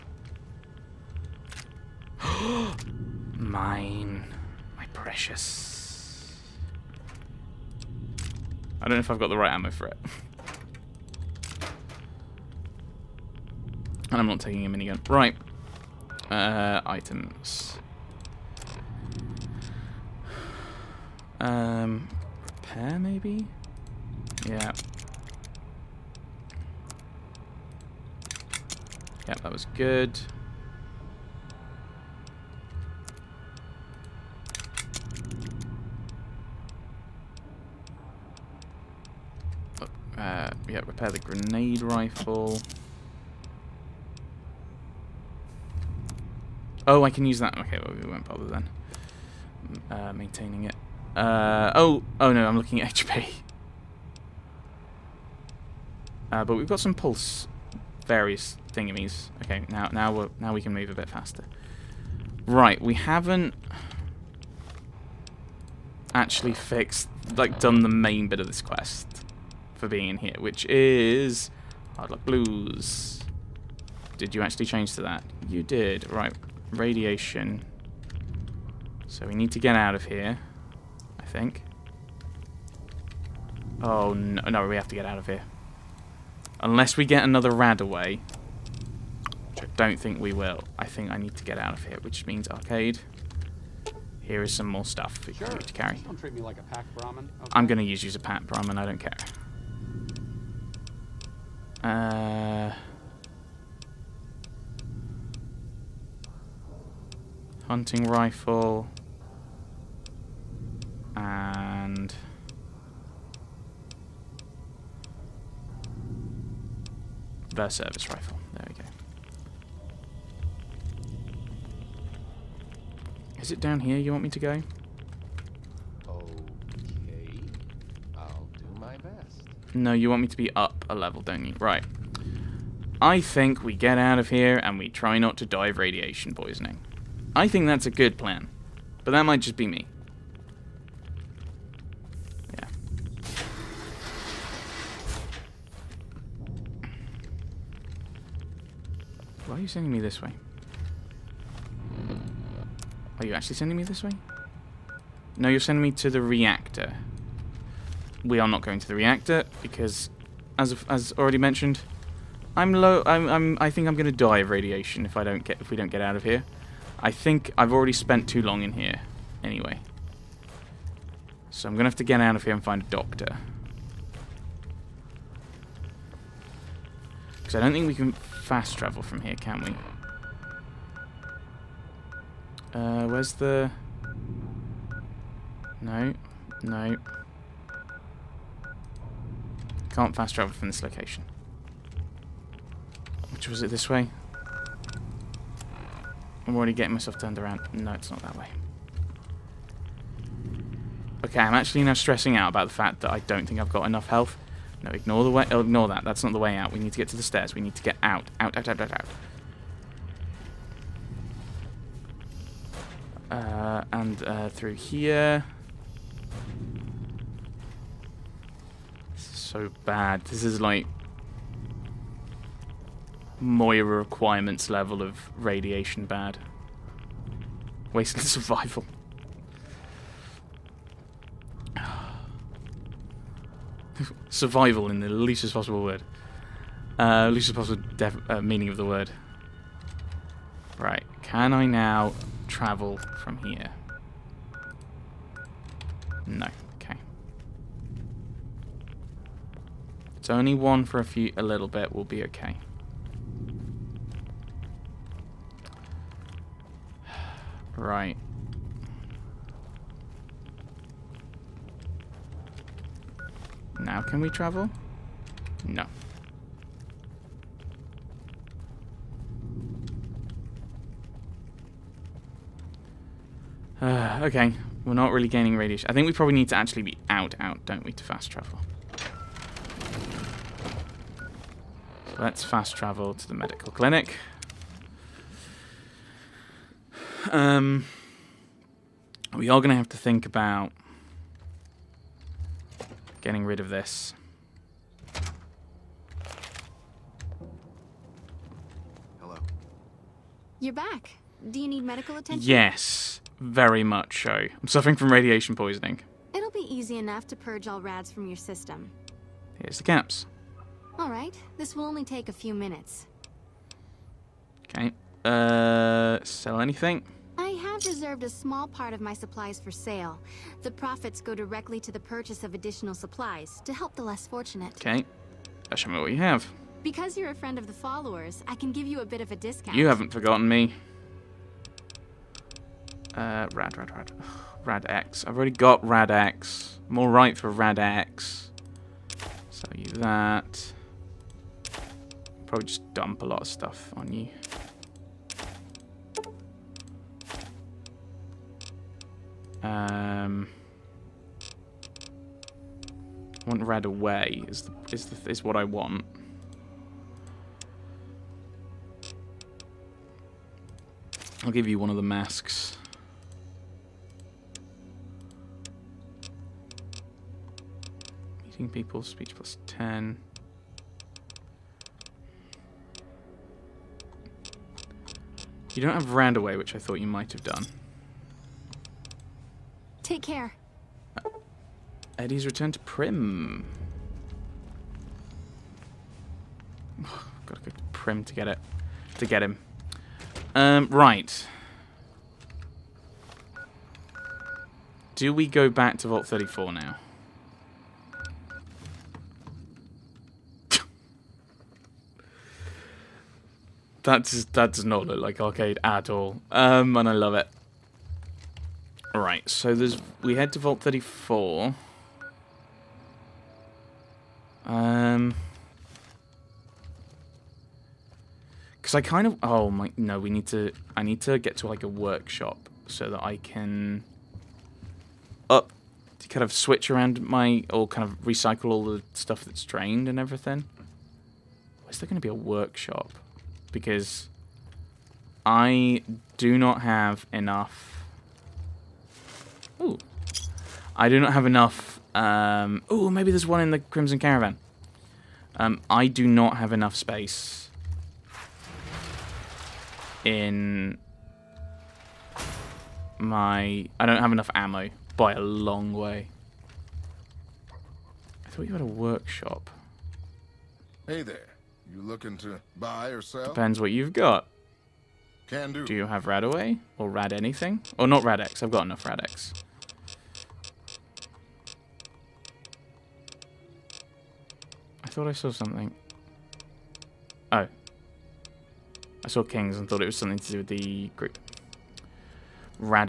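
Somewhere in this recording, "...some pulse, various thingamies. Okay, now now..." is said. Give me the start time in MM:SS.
00:56.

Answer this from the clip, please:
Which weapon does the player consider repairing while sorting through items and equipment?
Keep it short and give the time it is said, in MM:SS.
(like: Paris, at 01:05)
Grenade rifle, at 00:41.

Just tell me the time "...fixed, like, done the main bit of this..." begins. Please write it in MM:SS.
01:06.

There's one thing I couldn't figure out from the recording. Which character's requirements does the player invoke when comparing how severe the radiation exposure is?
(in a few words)
Moira.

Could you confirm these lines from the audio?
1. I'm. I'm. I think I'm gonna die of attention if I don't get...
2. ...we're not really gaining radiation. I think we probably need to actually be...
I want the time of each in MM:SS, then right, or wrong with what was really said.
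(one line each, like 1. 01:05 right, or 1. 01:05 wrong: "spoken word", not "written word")
1. 02:43 wrong: "radiation", not "attention"
2. 04:34 right.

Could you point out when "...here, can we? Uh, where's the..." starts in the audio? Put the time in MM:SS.
02:59.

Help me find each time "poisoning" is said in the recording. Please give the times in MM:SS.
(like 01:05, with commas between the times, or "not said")
02:16, 05:05.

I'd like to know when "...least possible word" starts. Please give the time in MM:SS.
03:55.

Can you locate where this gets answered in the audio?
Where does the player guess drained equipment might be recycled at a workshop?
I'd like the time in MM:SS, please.
07:23.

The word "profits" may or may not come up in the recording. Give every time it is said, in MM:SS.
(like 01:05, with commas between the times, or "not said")
05:20.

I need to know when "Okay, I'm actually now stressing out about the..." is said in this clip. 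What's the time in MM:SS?
03:21.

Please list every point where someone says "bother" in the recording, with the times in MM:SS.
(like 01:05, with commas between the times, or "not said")
00:48.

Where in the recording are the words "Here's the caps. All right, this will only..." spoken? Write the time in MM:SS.
05:09.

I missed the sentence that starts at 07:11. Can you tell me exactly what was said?
Is there going to be a workshop?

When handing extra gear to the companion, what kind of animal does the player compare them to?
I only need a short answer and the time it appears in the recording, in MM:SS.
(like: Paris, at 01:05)
Pack Brahmin, at 01:38.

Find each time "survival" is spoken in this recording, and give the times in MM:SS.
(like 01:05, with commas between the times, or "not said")
03:48, 03:54.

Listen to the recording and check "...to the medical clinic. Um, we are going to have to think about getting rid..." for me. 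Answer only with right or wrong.
right.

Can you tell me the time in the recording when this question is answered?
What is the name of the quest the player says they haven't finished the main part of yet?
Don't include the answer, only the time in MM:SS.
01:11.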